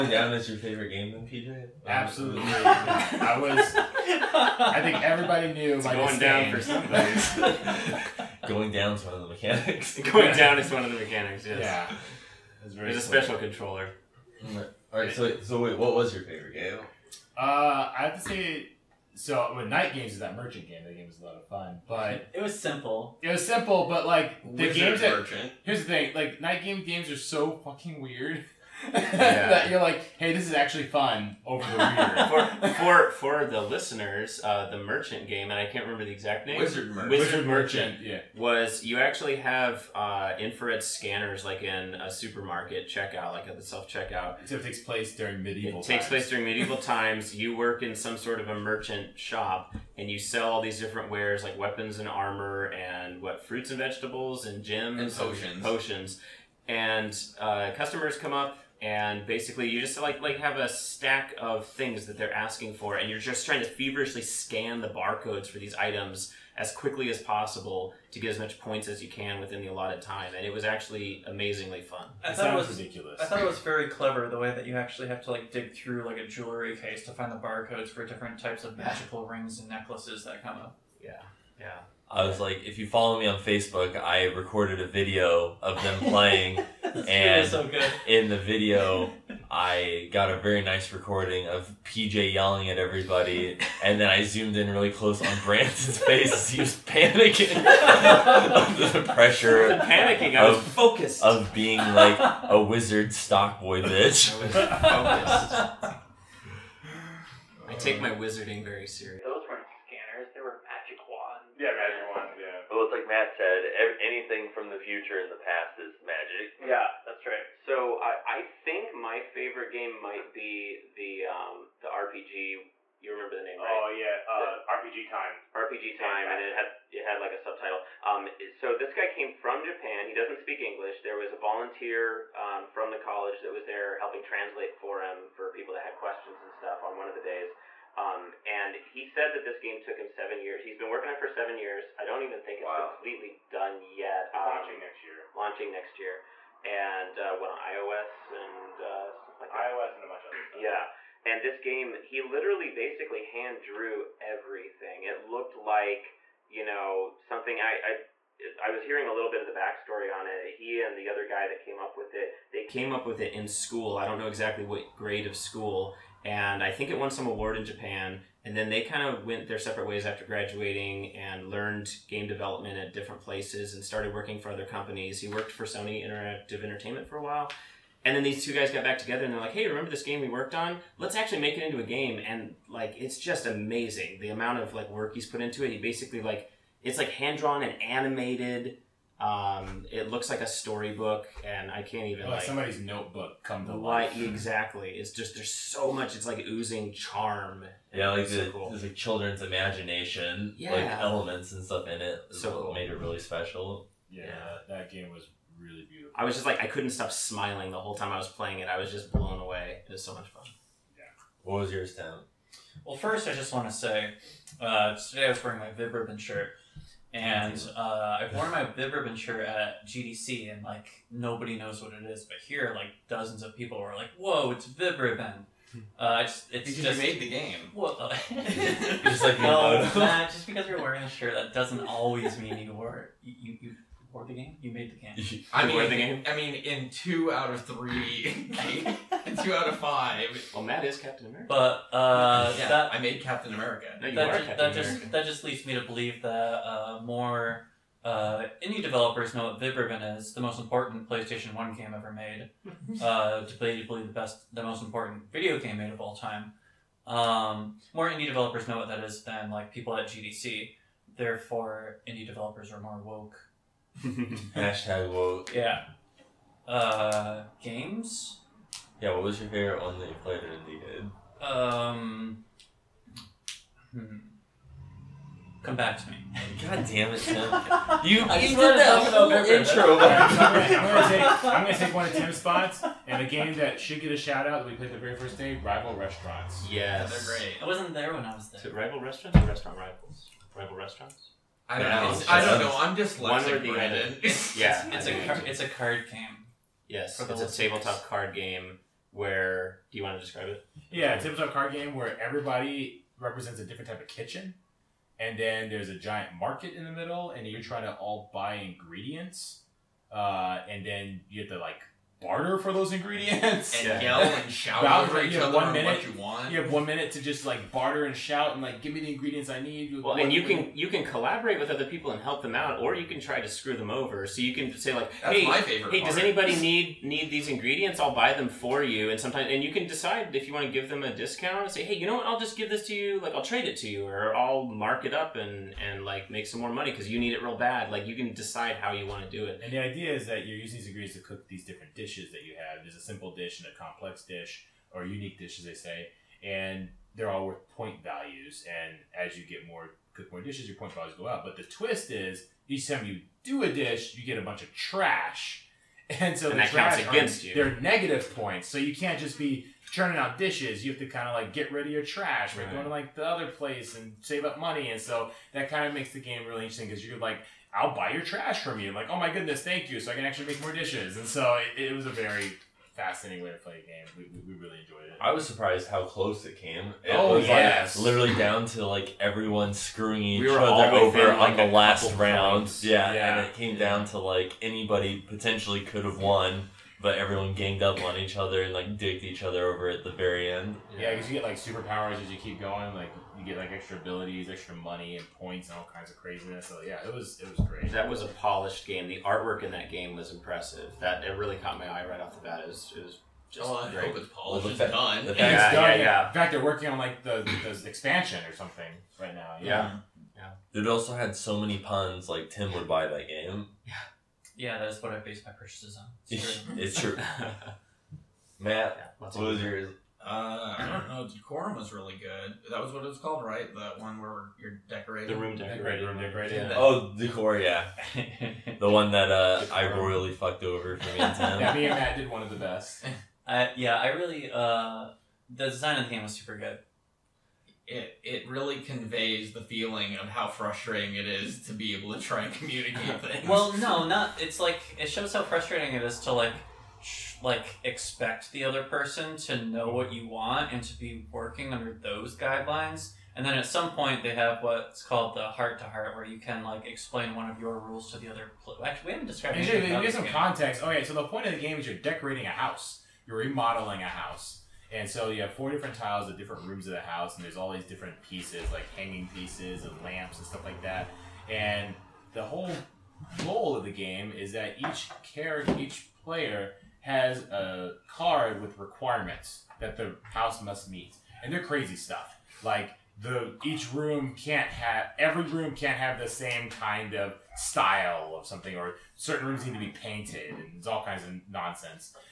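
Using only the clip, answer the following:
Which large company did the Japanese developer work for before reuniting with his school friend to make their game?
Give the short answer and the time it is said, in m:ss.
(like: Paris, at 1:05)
Sony Interactive Entertainment, at 2:55.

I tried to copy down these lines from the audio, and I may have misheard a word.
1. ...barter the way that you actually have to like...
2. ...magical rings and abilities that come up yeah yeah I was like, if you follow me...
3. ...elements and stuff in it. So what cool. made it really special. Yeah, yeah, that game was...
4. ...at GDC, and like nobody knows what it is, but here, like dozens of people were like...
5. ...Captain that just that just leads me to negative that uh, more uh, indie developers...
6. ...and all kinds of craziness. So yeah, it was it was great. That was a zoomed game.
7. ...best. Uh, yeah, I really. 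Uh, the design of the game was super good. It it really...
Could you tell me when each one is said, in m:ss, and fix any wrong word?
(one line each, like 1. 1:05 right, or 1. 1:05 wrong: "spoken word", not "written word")
1. 1:13 wrong: "clever", not "barter"
2. 1:18 wrong: "necklaces", not "abilities"
3. 3:20 right
4. 3:39 right
5. 4:04 wrong: "believe", not "negative"
6. 6:35 wrong: "polished", not "zoomed"
7. 7:12 right.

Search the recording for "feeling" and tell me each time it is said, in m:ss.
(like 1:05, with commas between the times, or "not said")
7:19.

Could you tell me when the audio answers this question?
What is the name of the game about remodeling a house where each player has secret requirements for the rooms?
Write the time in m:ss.
7:01.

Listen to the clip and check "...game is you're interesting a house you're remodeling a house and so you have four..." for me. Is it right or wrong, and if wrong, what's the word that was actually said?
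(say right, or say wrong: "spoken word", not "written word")
wrong: "decorating", not "interesting".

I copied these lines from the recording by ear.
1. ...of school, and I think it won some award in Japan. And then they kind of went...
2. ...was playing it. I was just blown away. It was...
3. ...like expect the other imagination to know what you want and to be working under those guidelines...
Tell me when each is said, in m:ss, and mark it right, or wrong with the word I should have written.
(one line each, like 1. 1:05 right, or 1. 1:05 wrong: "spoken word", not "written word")
1. 2:45 right
2. 3:28 right
3. 7:27 wrong: "person", not "imagination".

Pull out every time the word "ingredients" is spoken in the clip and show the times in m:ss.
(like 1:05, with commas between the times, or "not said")
5:08, 5:12, 5:19, 5:27, 5:40.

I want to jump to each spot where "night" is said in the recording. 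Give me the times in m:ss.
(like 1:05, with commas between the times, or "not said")
0:19, 0:26.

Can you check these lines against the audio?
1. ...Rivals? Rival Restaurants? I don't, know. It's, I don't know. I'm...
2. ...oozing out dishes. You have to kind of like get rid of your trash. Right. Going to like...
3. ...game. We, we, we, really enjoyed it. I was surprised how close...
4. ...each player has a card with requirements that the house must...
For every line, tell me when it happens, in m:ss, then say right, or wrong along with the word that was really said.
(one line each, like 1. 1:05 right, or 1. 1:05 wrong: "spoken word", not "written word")
1. 4:49 right
2. 5:59 wrong: "churning", not "oozing"
3. 6:13 right
4. 7:55 right.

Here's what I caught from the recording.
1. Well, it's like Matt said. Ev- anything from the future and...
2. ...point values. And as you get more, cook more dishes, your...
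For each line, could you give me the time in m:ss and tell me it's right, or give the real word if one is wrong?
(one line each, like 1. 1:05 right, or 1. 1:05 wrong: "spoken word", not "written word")
1. 1:52 right
2. 5:47 right.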